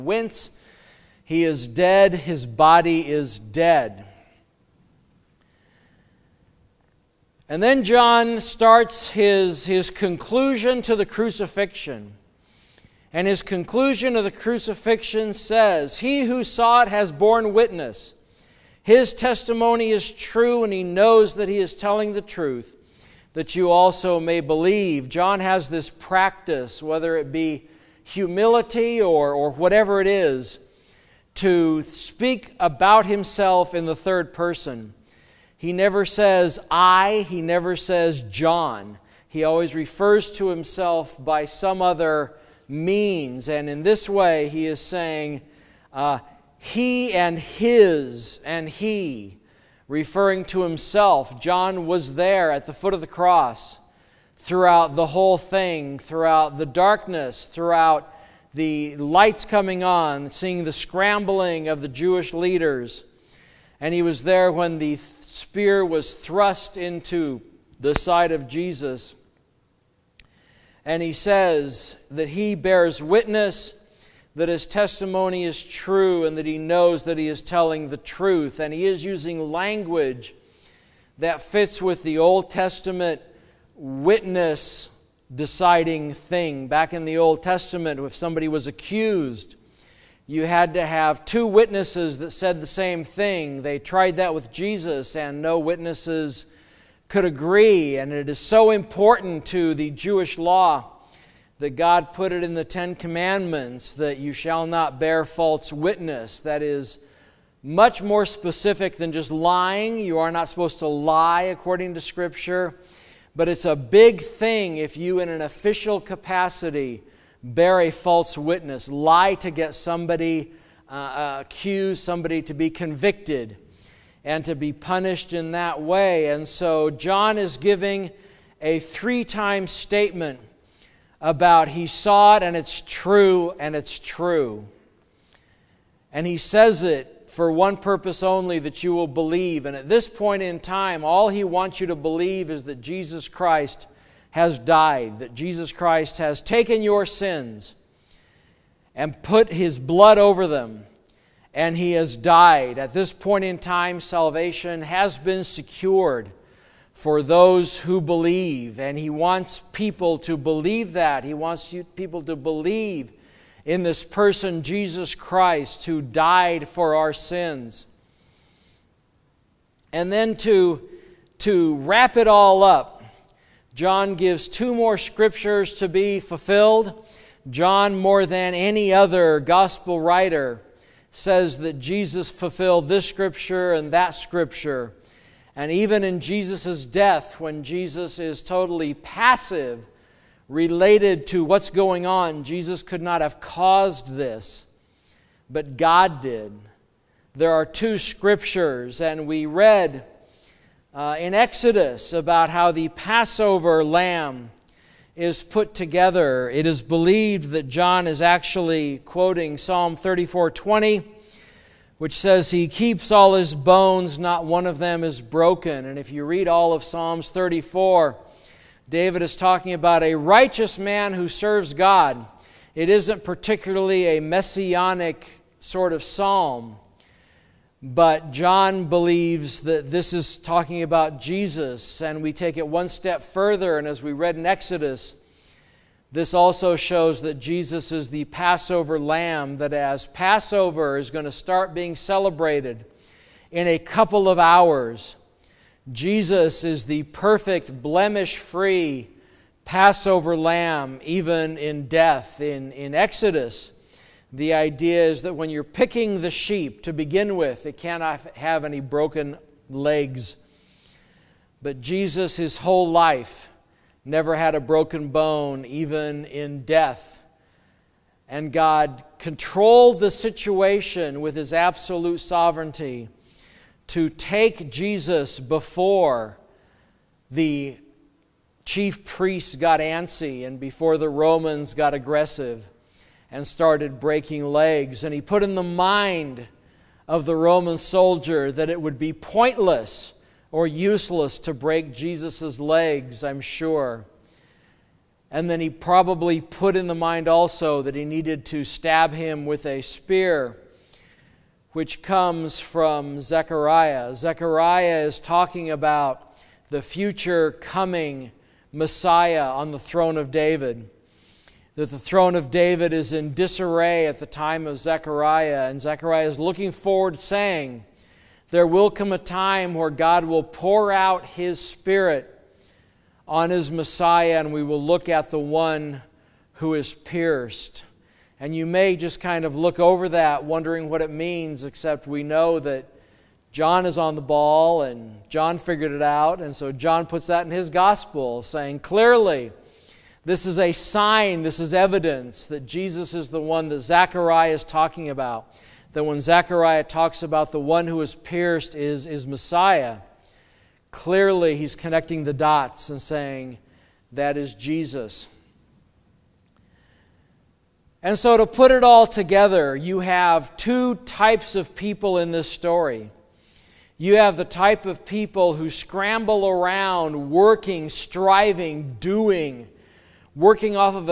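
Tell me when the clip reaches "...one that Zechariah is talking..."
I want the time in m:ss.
5:43.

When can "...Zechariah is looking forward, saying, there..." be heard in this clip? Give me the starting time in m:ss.
5:15.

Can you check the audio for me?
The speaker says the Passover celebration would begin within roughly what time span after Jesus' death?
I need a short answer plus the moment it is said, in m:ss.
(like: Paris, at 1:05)
a couple of hours, at 4:03.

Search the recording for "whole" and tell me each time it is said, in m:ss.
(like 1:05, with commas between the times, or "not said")
0:55, 4:22.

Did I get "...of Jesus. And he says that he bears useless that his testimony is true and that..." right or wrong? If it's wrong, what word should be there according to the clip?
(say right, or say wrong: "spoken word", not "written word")
wrong: "witness", not "useless".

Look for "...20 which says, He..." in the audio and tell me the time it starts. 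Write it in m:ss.
3:30.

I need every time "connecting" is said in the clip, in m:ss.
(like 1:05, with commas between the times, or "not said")
5:51.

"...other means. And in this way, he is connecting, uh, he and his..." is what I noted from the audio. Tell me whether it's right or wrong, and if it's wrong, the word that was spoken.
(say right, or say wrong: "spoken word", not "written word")
wrong: "saying", not "connecting".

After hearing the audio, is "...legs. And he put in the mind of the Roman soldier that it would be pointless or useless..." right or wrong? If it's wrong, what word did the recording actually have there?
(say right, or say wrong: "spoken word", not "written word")
right.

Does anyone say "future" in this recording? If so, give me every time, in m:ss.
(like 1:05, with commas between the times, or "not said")
5:06.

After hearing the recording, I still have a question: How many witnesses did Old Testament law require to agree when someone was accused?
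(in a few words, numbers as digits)
2.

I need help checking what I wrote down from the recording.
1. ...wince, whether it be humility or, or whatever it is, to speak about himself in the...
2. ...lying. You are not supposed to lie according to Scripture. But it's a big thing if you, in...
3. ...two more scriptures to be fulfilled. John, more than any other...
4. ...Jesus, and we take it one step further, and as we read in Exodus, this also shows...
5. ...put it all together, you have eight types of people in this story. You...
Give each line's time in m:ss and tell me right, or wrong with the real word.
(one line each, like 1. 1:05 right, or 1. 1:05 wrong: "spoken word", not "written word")
1. 0:25 wrong: "practice", not "wince"
2. 1:49 right
3. 2:54 right
4. 3:51 right
5. 5:58 wrong: "two", not "eight".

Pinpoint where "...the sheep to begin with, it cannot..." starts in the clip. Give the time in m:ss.
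4:16.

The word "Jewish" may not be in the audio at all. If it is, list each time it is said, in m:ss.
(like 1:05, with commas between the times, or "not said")
1:01, 1:39.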